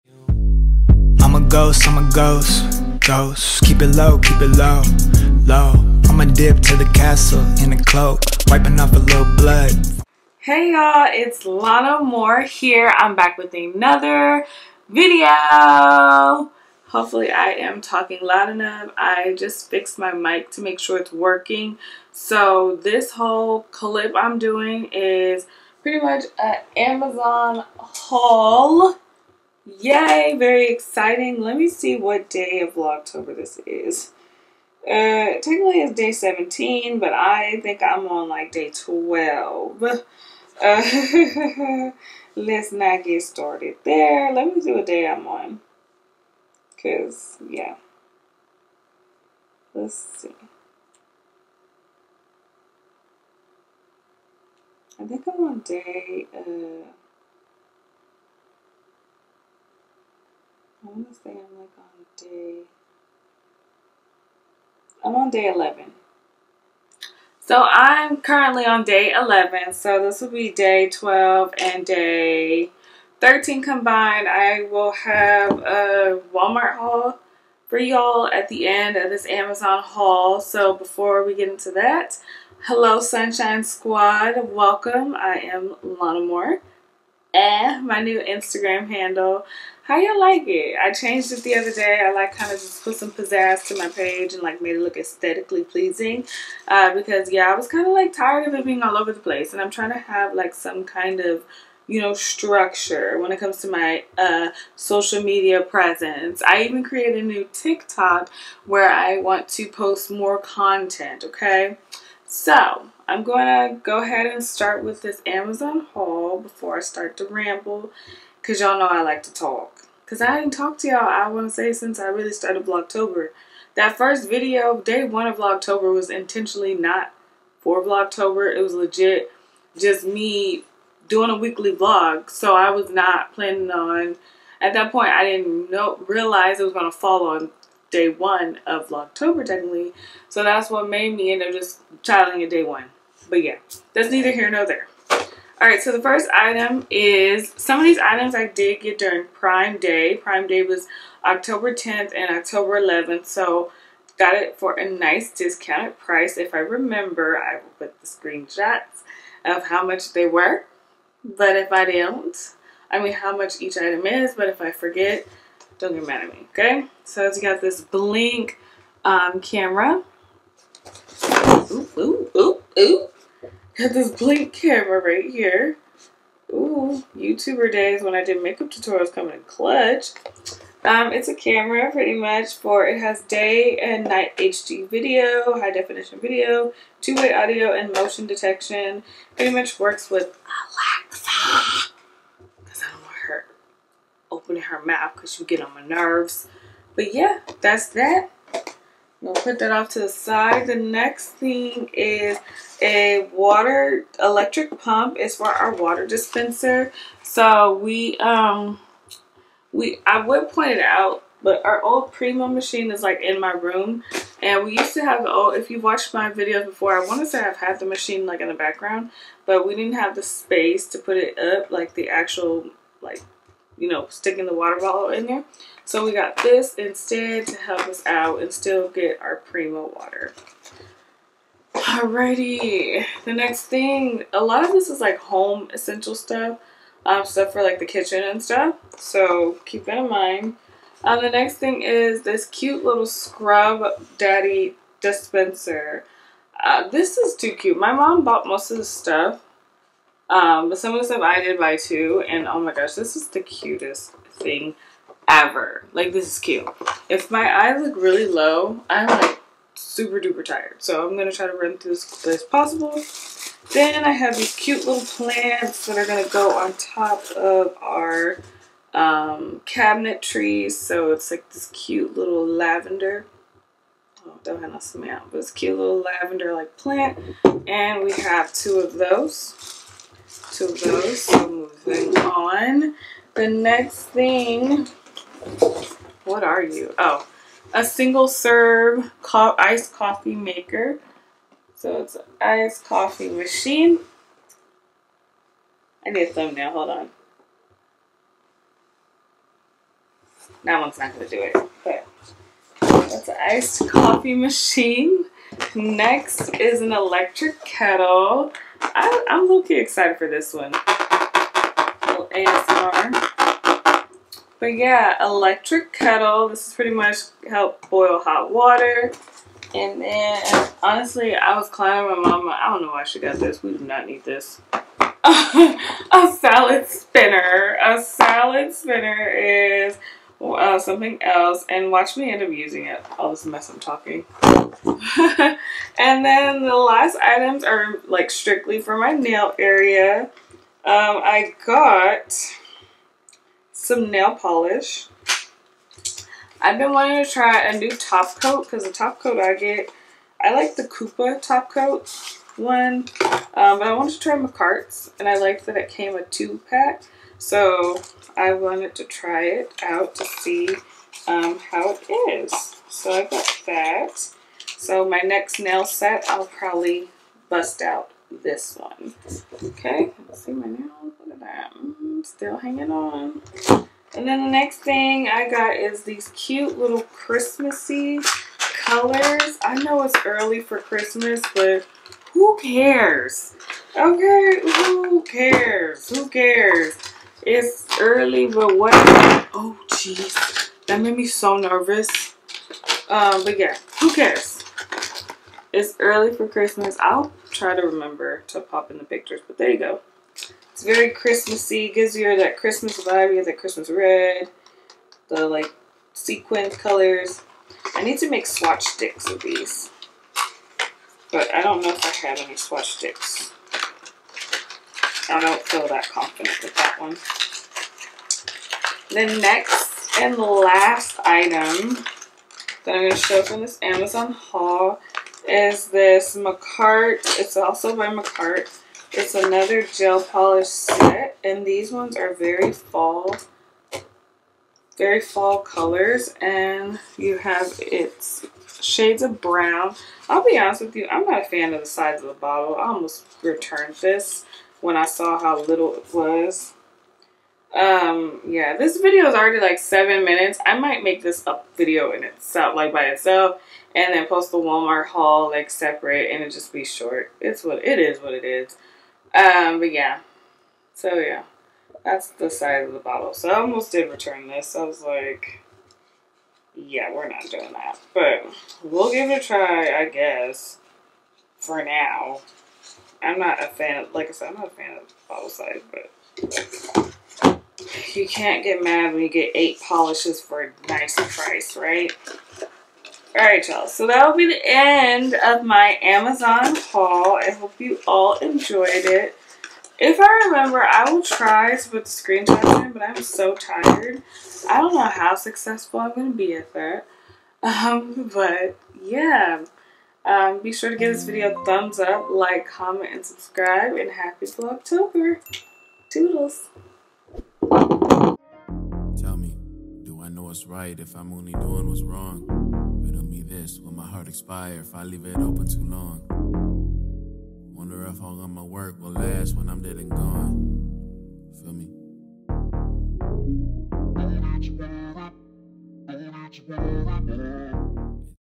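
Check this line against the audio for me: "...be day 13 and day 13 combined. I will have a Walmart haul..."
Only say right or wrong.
wrong.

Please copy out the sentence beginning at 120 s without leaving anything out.
Because I ain't talked to y'all, I want to say, since I really started Vlogtober.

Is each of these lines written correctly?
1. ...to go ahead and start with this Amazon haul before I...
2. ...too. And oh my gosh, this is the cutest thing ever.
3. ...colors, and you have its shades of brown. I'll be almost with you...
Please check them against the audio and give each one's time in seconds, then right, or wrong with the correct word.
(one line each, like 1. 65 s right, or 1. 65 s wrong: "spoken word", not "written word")
1. 113 s right
2. 251 s right
3. 435 s wrong: "honest", not "almost".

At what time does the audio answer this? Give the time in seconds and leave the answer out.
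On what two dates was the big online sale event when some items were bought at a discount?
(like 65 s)
151 s.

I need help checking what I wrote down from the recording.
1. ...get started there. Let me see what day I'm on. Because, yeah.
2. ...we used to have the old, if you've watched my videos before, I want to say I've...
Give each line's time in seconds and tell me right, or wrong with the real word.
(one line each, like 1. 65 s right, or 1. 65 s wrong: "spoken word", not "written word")
1. 43 s right
2. 214 s right.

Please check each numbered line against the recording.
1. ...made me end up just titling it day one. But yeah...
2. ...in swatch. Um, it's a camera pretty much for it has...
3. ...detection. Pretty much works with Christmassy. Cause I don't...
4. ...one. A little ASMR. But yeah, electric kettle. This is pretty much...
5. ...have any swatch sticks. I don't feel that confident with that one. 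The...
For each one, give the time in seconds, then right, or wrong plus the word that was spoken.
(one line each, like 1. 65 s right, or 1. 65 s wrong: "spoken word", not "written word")
1. 140 s right
2. 179 s wrong: "clutch", not "swatch"
3. 188 s wrong: "Alexa", not "Christmassy"
4. 310 s right
5. 412 s right.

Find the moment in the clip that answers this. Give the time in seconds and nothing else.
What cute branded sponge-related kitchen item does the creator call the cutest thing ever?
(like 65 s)
243 s.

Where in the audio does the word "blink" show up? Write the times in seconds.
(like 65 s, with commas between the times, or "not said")
167 s, 174 s.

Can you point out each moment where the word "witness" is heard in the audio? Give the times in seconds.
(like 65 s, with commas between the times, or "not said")
not said.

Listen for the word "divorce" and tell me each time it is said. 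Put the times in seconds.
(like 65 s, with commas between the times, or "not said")
not said.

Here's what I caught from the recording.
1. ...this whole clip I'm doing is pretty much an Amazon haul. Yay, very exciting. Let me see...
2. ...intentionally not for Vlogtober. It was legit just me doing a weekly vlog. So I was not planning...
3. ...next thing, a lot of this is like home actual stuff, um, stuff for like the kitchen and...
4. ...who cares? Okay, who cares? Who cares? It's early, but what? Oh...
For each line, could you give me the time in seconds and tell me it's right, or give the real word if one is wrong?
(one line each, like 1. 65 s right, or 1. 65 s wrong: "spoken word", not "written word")
1. 22 s right
2. 126 s right
3. 233 s wrong: "essential", not "actual"
4. 382 s right.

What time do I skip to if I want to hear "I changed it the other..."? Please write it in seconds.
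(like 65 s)
90 s.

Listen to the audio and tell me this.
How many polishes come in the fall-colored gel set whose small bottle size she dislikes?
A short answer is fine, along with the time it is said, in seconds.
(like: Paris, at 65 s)
8, at 479 s.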